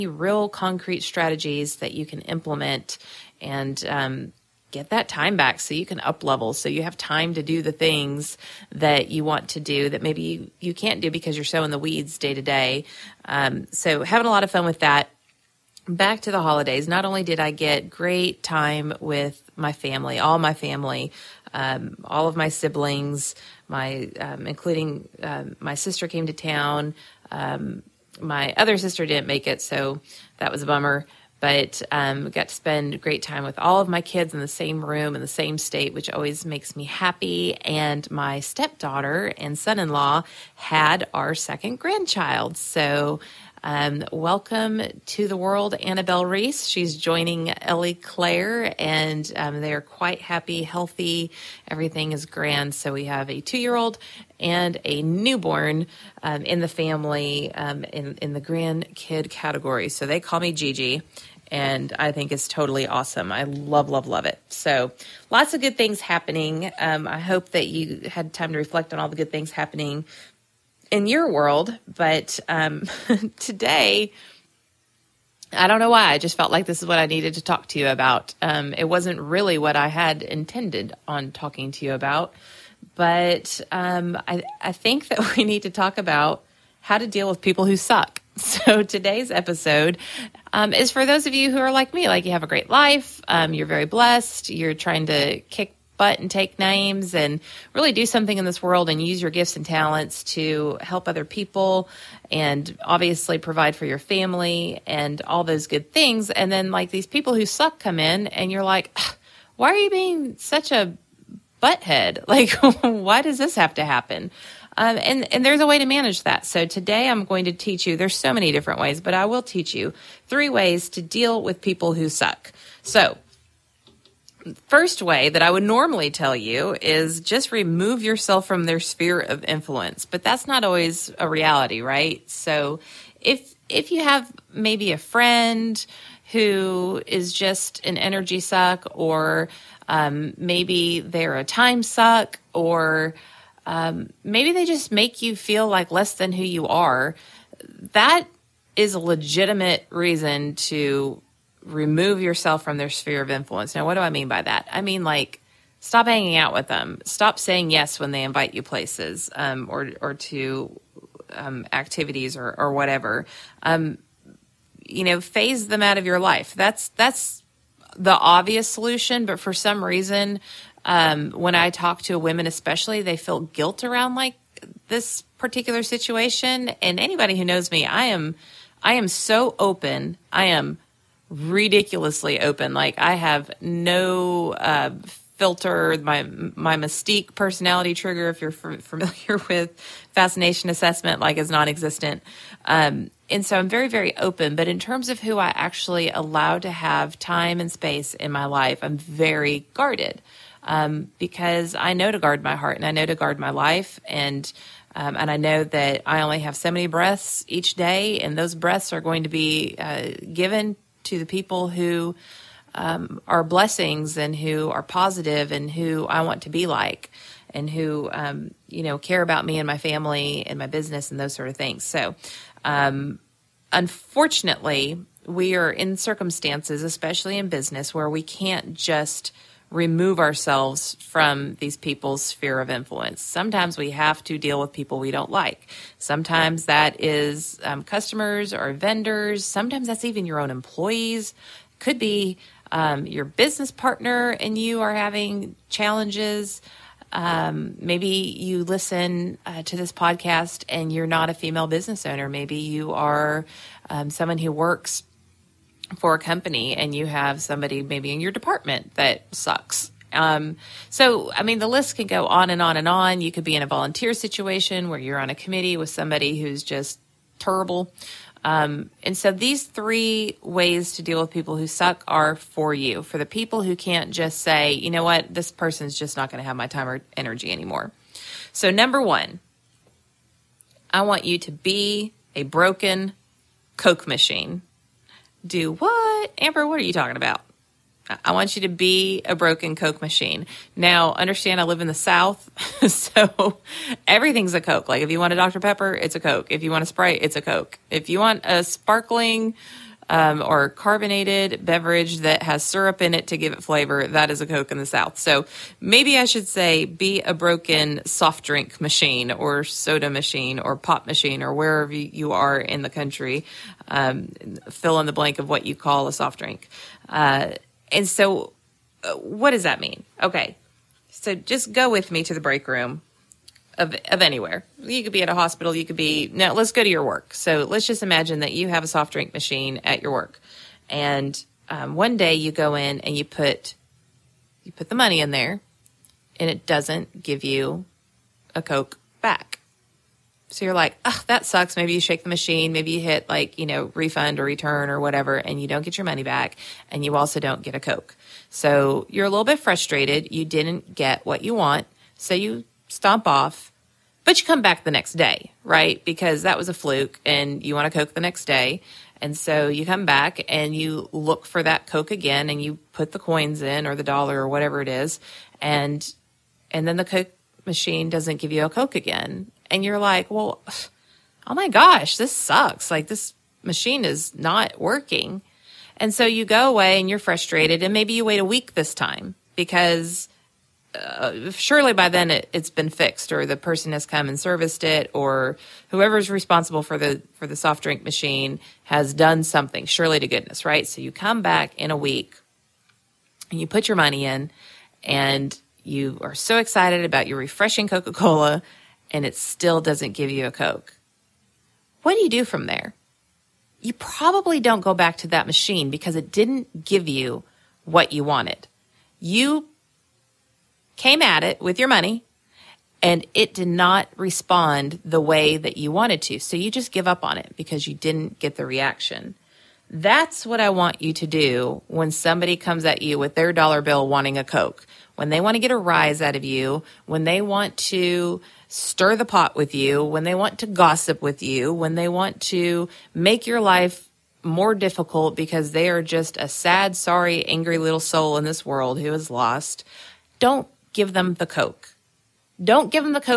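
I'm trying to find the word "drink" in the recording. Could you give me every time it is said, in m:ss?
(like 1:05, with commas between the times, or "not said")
5:08, 5:16, 5:29, 6:27.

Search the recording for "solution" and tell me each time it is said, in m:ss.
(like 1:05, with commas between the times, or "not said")
2:48.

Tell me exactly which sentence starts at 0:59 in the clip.
So they call me Gigi and I think it's totally awesome.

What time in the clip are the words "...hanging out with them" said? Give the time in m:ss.
2:36.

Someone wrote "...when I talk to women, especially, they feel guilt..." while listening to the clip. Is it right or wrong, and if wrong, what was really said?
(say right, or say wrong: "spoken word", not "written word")
right.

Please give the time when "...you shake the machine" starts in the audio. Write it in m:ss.
5:41.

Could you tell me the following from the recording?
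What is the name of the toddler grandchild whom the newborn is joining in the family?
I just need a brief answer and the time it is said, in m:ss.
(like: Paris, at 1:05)
Ellie Claire, at 0:47.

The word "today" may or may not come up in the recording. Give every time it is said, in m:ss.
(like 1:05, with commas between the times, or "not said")
1:13, 1:28, 1:56.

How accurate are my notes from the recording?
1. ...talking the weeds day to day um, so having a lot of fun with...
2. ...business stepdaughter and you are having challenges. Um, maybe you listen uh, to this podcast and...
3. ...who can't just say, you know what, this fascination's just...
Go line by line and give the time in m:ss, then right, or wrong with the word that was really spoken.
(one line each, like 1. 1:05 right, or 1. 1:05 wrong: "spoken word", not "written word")
1. 0:11 wrong: "sowing", not "talking"
2. 4:03 wrong: "partner", not "stepdaughter"
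3. 4:33 wrong: "person", not "fascination".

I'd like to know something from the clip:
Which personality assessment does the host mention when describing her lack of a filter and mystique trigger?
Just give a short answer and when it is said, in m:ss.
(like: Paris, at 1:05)
Fascination assessment, at 3:10.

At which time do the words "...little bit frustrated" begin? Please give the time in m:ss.
5:49.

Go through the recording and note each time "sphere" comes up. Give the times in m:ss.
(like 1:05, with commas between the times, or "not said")
2:08, 2:32, 3:52.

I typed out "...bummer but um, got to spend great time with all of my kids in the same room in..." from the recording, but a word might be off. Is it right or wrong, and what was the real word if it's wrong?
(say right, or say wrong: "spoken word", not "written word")
right.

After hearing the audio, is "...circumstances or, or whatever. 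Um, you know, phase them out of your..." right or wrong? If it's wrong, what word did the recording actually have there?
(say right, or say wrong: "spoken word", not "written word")
wrong: "activities", not "circumstances".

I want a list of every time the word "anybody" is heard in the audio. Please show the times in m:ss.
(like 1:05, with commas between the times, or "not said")
2:57.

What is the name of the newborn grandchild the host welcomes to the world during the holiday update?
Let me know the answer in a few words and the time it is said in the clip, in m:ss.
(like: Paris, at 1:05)
Annabelle Reese, at 0:45.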